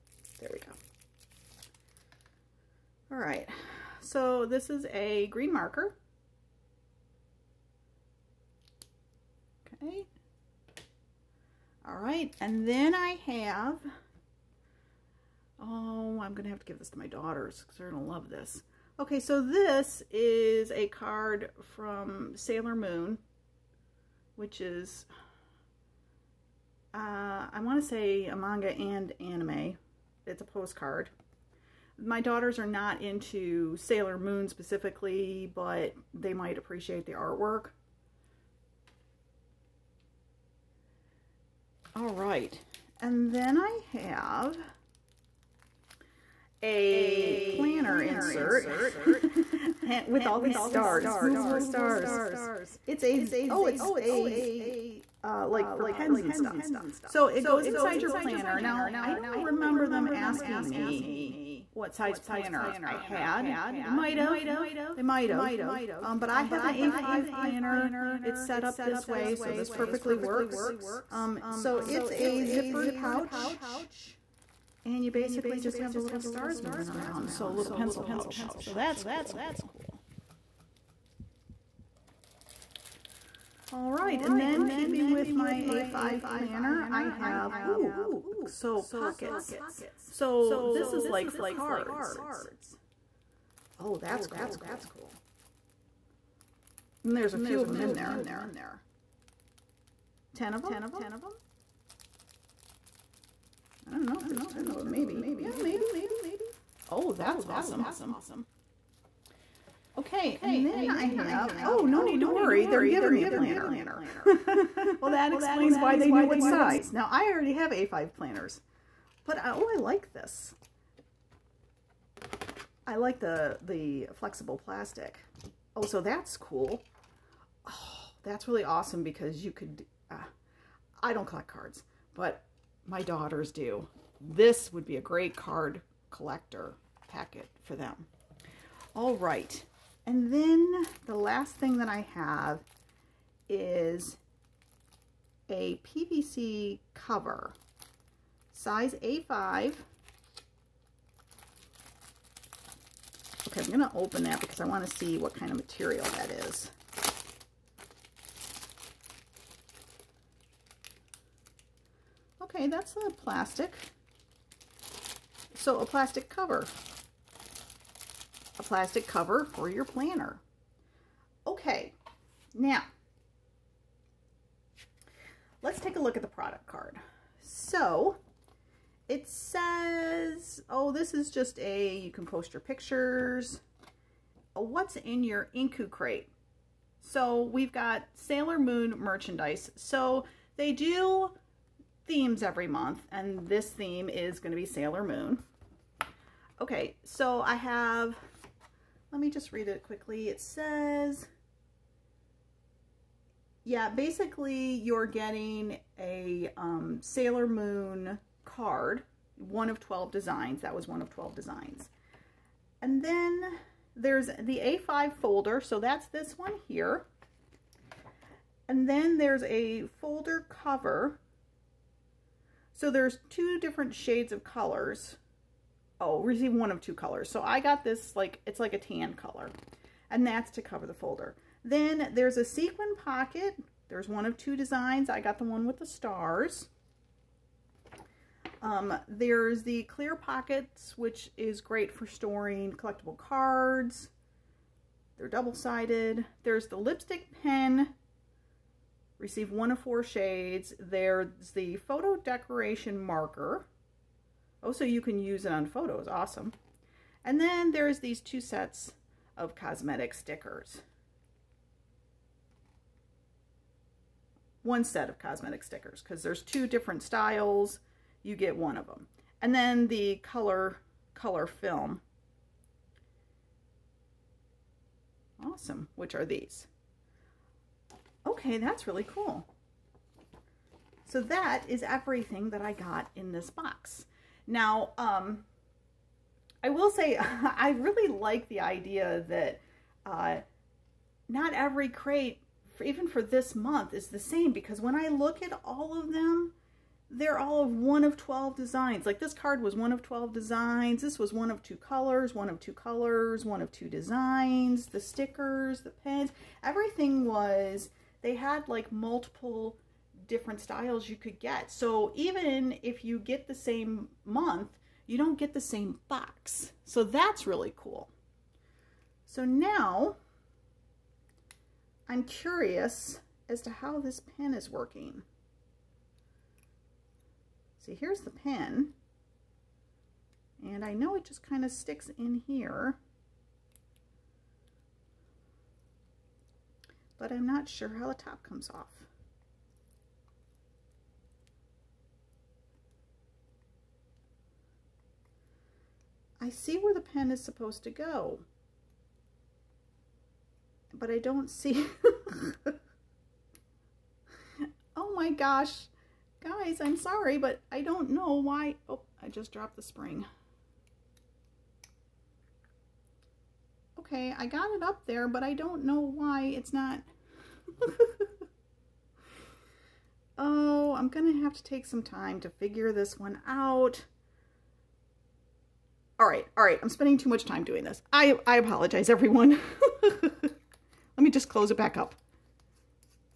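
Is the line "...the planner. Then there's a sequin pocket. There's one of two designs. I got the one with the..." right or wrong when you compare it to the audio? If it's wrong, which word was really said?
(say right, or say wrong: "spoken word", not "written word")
wrong: "folder", not "planner".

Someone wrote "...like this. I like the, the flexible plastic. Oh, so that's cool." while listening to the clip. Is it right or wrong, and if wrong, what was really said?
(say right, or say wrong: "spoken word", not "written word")
right.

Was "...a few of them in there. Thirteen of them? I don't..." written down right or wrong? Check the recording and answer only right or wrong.
wrong.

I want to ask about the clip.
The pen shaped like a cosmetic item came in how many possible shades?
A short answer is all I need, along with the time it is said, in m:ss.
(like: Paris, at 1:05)
4, at 4:09.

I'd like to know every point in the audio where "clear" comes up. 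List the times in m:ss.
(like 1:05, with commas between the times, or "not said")
3:59.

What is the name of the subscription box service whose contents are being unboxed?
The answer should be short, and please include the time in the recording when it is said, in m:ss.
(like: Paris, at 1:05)
Inku crate, at 3:05.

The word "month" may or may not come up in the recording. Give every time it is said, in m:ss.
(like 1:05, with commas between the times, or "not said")
3:12, 4:53, 5:14.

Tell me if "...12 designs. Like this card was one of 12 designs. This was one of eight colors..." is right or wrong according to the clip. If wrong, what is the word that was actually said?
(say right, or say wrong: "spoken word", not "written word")
wrong: "two", not "eight".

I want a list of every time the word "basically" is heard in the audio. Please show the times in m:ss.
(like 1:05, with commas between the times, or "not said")
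1:15, 3:23.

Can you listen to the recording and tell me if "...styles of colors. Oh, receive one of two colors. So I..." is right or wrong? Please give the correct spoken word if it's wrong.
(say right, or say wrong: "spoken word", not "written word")
wrong: "shades", not "styles".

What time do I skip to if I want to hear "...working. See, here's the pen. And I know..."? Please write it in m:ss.
5:24.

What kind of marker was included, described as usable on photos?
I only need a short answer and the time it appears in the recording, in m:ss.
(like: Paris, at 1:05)
photo decoration marker, at 4:11.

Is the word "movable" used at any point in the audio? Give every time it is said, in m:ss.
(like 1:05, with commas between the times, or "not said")
0:51.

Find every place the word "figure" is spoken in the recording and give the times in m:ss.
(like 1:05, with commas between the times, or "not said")
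6:12.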